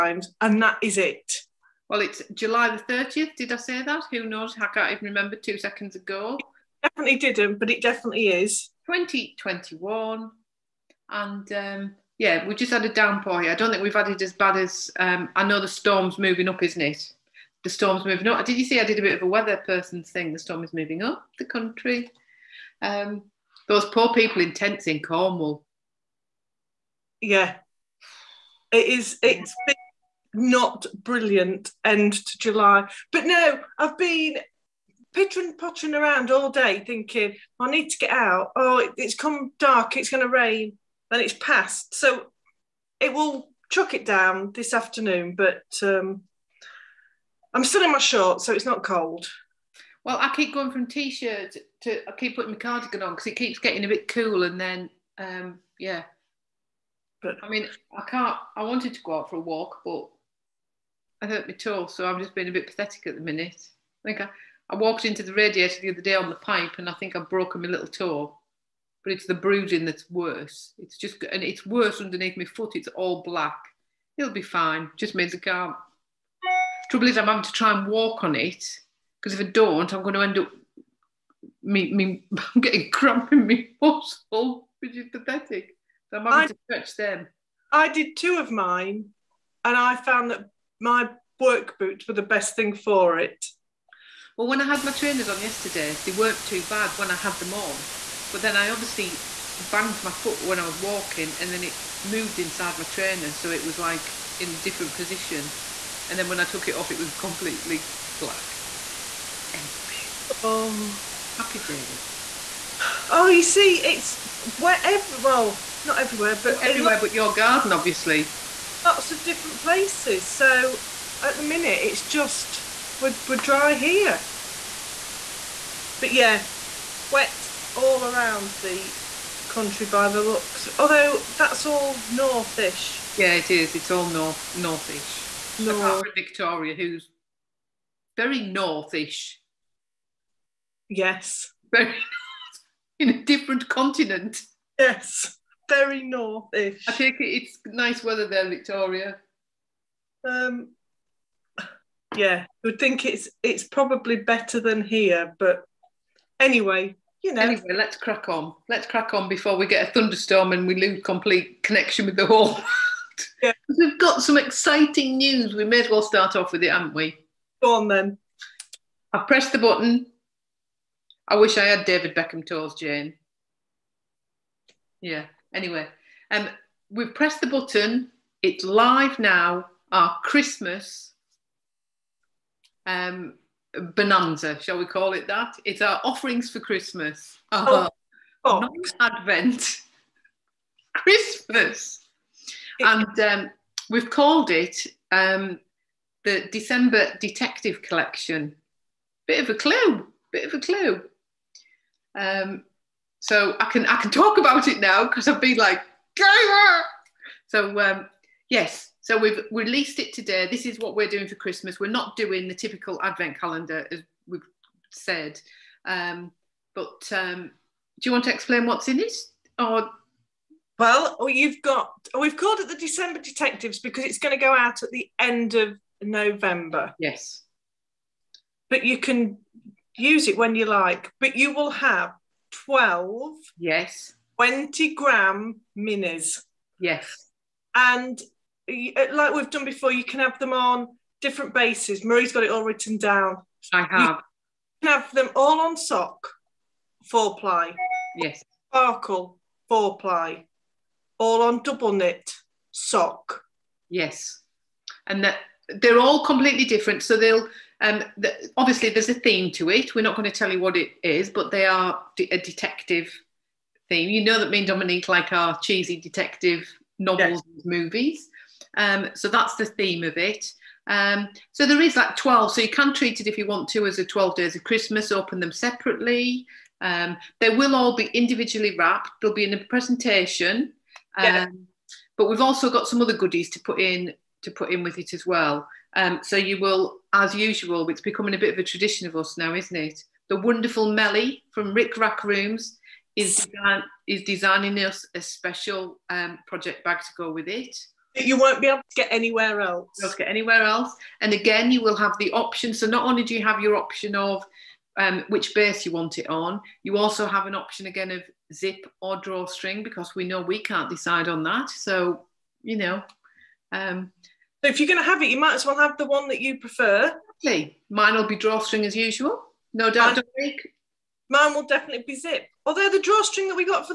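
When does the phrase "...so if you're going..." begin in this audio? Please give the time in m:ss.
5:14.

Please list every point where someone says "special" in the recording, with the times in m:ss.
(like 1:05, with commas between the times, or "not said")
4:55.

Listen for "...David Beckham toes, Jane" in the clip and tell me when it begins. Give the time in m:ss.
2:51.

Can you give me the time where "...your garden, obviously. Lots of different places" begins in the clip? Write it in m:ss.
1:57.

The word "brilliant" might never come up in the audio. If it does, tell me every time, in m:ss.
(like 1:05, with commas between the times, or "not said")
0:31.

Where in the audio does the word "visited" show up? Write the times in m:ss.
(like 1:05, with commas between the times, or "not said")
not said.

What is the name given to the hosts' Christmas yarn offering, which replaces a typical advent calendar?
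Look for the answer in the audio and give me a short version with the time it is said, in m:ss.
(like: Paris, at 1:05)
December Detective Collection, at 3:16.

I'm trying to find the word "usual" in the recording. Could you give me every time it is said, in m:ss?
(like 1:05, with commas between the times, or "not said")
4:47, 5:18.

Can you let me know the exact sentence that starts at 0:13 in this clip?
I don't think we've had it as bad as um, I know the storm's moving up, isn't it?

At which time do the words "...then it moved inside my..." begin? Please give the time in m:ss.
1:41.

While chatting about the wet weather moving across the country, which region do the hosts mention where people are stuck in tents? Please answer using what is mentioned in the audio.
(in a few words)
Cornwall.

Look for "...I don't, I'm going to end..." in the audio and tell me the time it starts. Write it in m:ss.
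1:19.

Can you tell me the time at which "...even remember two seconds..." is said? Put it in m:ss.
0:04.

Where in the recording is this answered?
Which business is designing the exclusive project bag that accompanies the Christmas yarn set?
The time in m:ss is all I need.
4:51.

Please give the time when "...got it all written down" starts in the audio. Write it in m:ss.
4:02.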